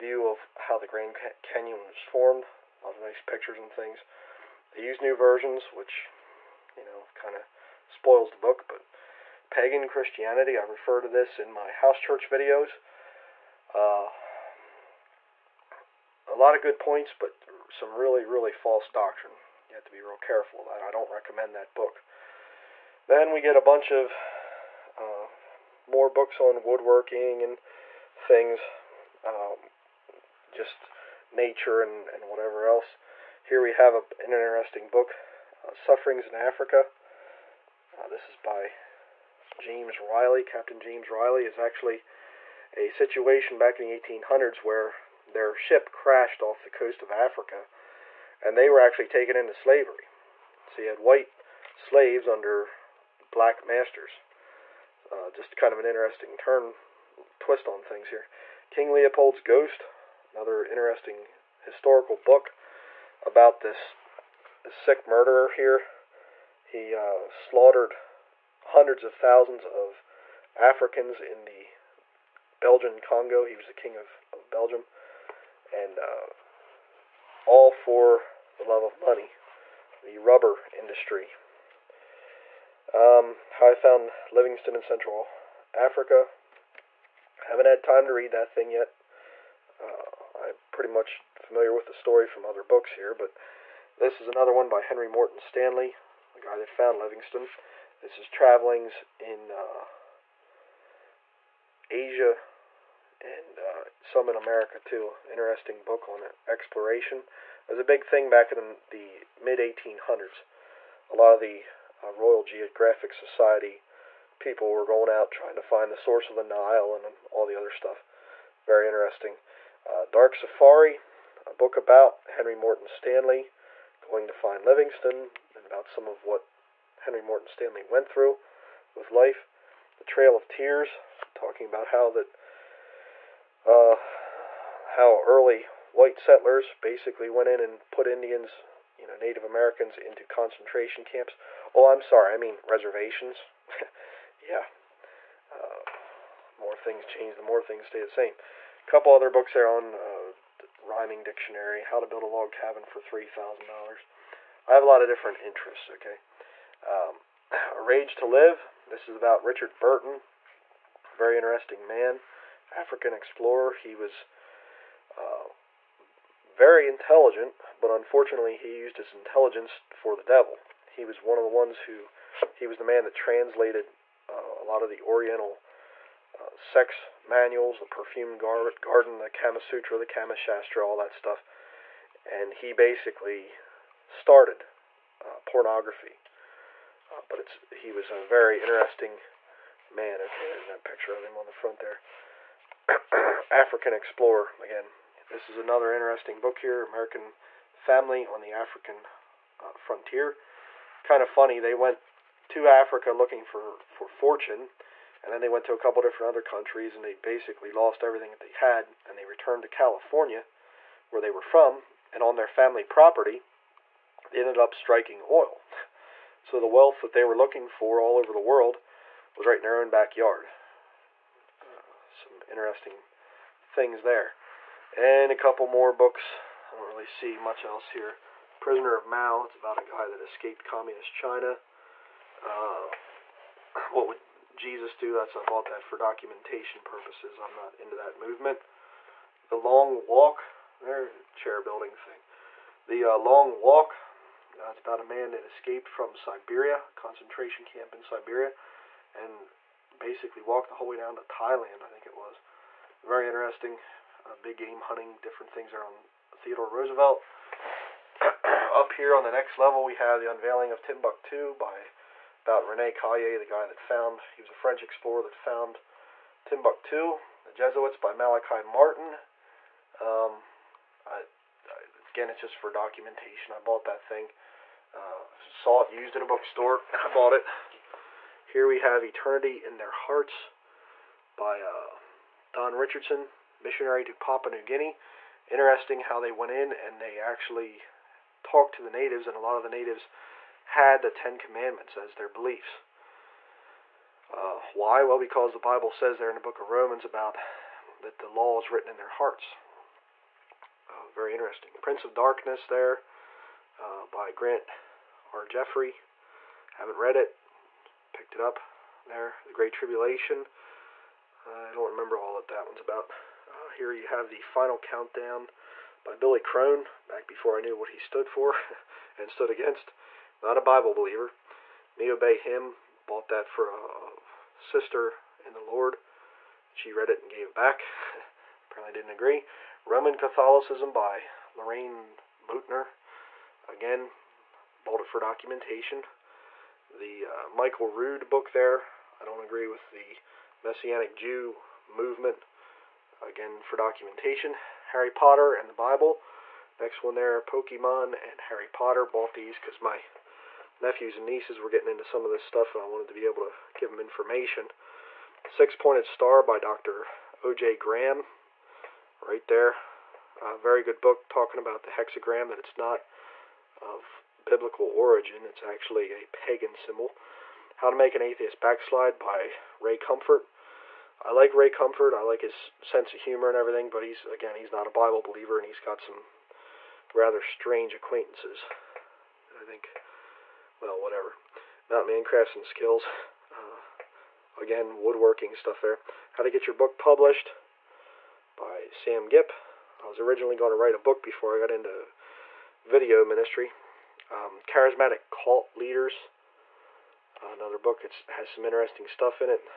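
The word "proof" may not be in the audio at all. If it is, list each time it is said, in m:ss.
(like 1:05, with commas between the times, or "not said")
not said.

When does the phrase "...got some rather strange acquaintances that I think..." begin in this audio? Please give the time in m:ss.
6:15.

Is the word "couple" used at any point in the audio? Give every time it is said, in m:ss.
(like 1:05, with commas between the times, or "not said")
2:28, 3:25, 3:45.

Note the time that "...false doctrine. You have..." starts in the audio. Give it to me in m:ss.
0:18.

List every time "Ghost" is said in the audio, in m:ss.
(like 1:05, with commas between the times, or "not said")
0:59.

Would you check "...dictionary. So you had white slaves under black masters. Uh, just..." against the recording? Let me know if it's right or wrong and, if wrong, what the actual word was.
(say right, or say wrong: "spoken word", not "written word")
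wrong: "slavery", not "dictionary".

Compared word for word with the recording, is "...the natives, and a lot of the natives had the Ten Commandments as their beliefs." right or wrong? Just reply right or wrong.
right.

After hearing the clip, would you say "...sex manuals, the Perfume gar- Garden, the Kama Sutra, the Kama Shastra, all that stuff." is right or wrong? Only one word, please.
right.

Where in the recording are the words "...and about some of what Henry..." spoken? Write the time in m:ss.
2:05.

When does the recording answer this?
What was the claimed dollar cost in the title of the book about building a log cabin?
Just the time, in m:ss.
2:33.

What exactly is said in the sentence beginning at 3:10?
Okay, there's that picture of him on the front there.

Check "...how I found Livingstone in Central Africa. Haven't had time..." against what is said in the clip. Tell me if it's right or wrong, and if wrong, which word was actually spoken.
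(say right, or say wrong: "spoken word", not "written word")
right.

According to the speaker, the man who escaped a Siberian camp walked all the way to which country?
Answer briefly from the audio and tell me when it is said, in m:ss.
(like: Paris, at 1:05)
Thailand, at 4:11.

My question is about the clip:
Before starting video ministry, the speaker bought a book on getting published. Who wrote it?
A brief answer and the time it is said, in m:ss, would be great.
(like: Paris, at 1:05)
Sam Gipp, at 6:28.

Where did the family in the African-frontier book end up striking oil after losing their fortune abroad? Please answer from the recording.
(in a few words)
California.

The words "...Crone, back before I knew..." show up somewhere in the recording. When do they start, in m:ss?
5:16.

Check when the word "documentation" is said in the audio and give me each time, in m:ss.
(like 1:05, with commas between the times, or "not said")
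3:55, 4:32, 5:35, 5:43.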